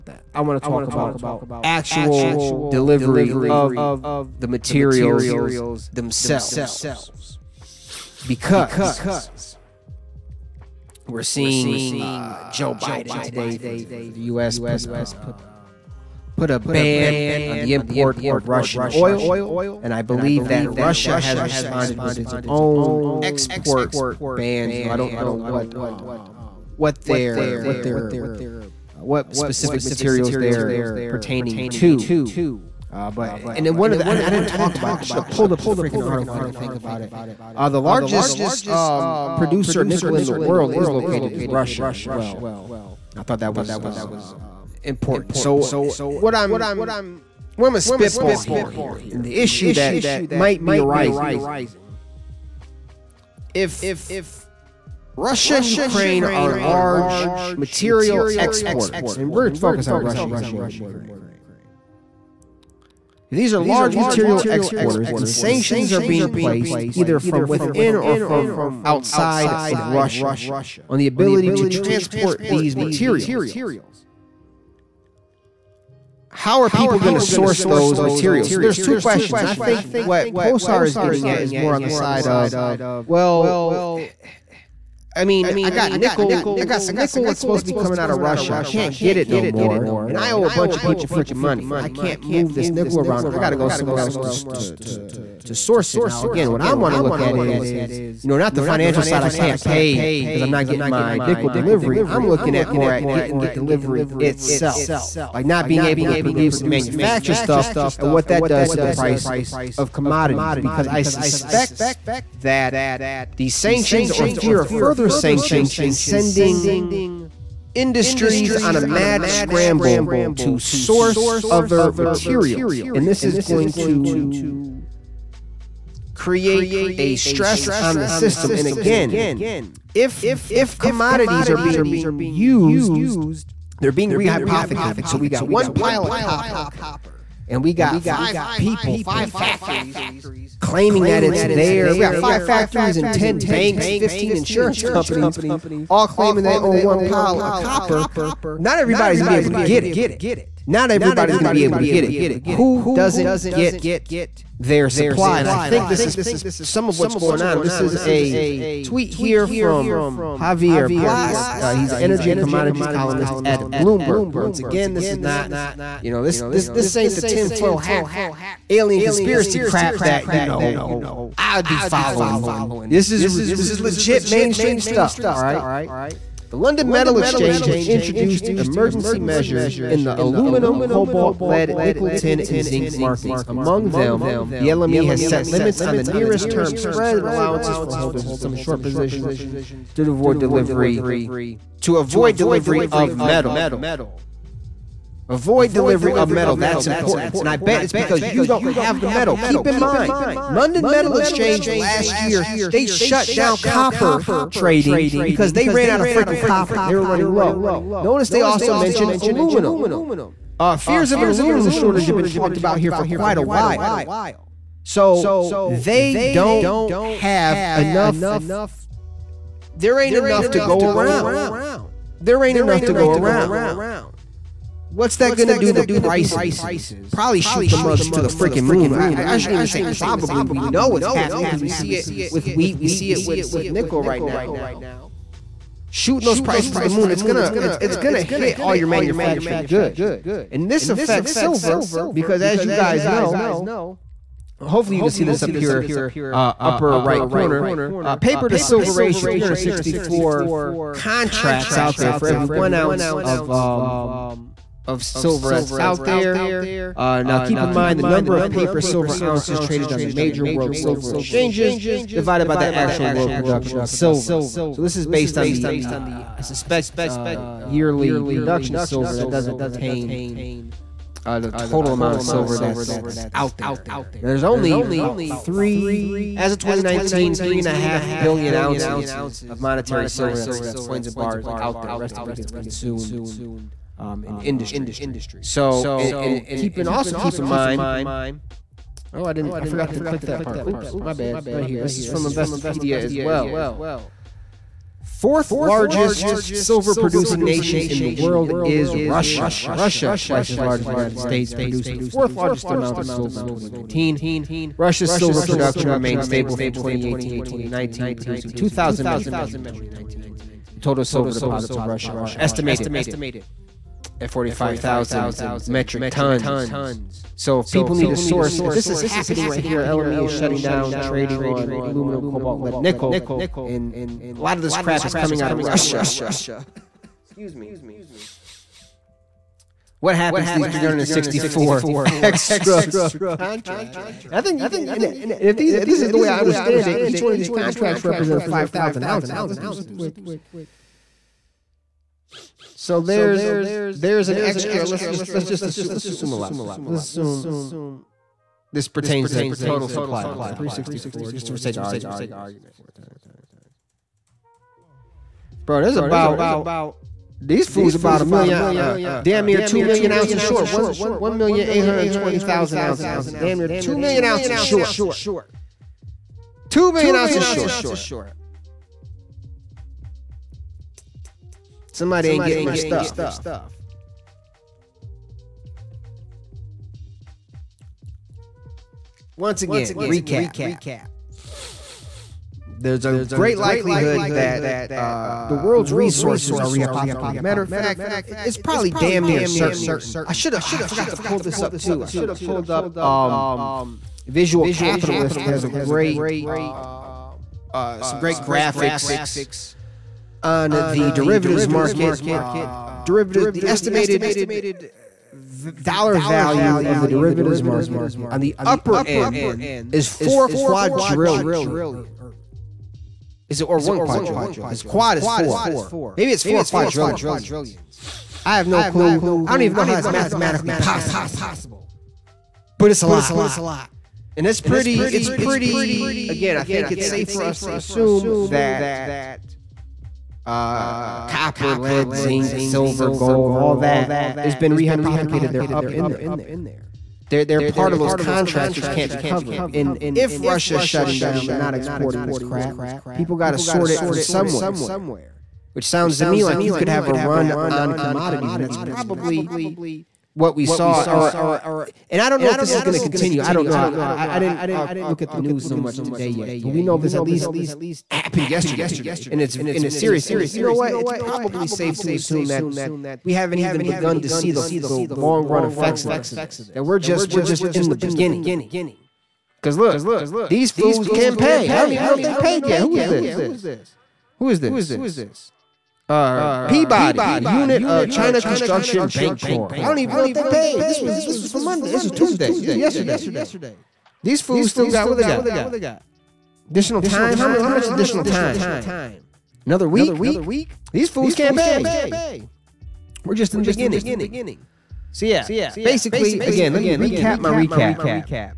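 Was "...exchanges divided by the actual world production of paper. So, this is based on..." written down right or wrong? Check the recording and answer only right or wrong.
wrong.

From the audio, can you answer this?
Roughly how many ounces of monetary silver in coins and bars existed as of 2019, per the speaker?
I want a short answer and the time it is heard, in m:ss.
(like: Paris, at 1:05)
3.5 billion ounces, at 4:37.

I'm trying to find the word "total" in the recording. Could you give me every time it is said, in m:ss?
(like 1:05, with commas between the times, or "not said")
4:31, 5:10, 5:49.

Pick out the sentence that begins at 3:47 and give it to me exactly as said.
Probably shoot the mugs to the freaking moon.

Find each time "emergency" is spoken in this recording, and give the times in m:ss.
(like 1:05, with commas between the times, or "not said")
2:58.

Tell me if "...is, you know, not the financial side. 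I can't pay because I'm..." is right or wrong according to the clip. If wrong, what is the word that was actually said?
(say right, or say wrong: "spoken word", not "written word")
right.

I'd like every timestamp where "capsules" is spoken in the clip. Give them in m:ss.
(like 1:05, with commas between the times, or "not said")
not said.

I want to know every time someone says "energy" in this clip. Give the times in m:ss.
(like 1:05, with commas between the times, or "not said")
2:41.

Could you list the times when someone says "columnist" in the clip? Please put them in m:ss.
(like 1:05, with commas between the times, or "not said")
2:42.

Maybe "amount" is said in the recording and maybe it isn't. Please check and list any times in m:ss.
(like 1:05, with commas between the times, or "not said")
4:31, 5:02.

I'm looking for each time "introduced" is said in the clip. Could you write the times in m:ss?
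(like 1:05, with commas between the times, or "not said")
2:57.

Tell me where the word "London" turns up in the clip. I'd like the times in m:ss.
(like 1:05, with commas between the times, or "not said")
2:56, 3:20.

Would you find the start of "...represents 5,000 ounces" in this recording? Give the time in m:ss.
5:38.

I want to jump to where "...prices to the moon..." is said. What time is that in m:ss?
3:56.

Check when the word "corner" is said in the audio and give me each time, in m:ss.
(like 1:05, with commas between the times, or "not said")
4:07.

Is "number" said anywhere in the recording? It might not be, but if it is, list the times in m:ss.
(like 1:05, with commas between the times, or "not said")
4:18.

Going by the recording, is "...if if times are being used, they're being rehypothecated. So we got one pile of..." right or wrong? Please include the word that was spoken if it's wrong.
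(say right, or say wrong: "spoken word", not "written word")
wrong: "commodities", not "times".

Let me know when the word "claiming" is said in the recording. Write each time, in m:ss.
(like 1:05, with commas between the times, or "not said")
2:20, 2:26.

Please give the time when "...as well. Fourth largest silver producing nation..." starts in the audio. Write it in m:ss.
4:52.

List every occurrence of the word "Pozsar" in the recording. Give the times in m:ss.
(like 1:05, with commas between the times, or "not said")
1:20.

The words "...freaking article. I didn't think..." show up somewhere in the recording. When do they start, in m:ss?
0:35.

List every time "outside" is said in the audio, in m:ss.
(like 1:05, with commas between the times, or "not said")
1:08.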